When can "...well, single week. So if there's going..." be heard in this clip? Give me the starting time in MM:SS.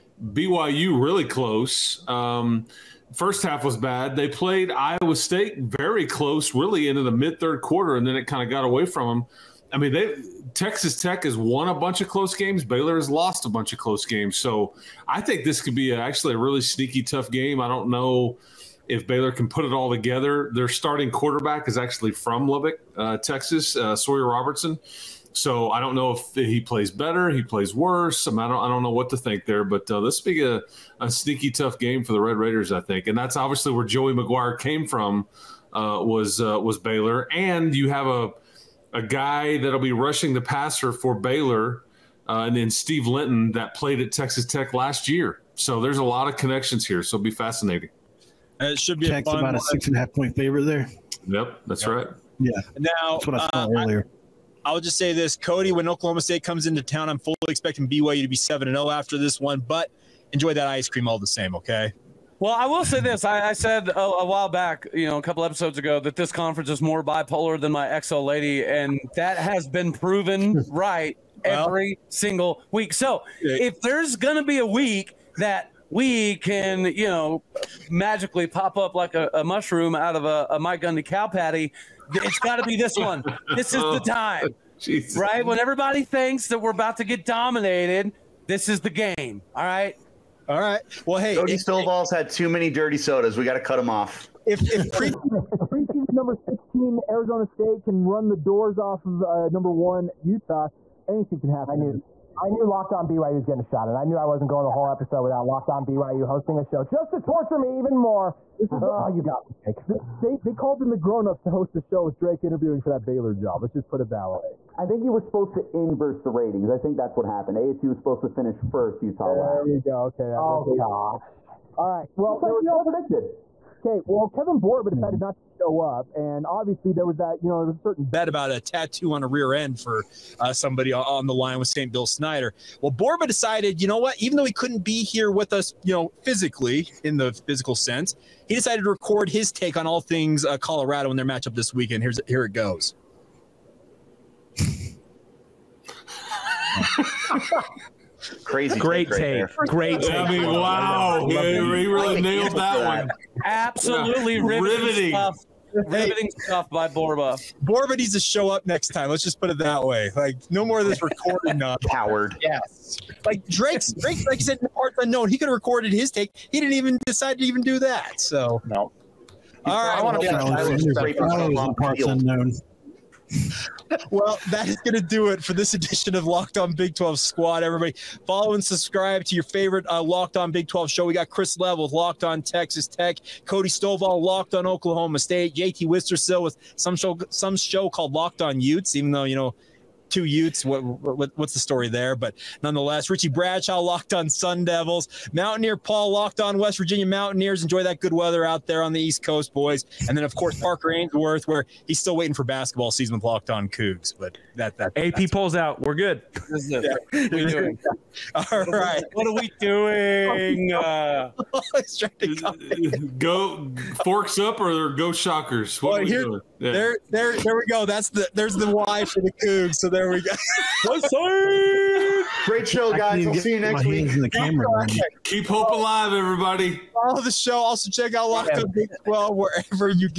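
01:11.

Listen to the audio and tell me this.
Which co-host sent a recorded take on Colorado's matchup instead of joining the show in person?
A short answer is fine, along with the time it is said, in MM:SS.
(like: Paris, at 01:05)
Kevin Borba, at 02:04.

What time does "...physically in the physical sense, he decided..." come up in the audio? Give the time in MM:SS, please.
02:16.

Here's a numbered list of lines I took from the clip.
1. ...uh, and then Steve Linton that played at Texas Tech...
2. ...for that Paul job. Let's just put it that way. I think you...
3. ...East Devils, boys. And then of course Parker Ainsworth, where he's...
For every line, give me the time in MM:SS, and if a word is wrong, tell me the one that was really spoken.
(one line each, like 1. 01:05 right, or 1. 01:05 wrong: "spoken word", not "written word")
1. 00:42 right
2. 01:52 wrong: "Baylor", not "Paul"
3. 03:18 wrong: "Coast", not "Devils".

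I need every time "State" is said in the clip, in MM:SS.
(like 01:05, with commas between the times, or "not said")
00:05, 00:56, 01:37, 03:05.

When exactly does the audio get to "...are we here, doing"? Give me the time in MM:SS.
03:35.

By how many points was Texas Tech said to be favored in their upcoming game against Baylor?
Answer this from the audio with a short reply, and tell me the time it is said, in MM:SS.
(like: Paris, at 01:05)
6.5, at 00:49.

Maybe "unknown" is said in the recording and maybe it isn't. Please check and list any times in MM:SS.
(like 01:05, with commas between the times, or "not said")
02:44, 02:52.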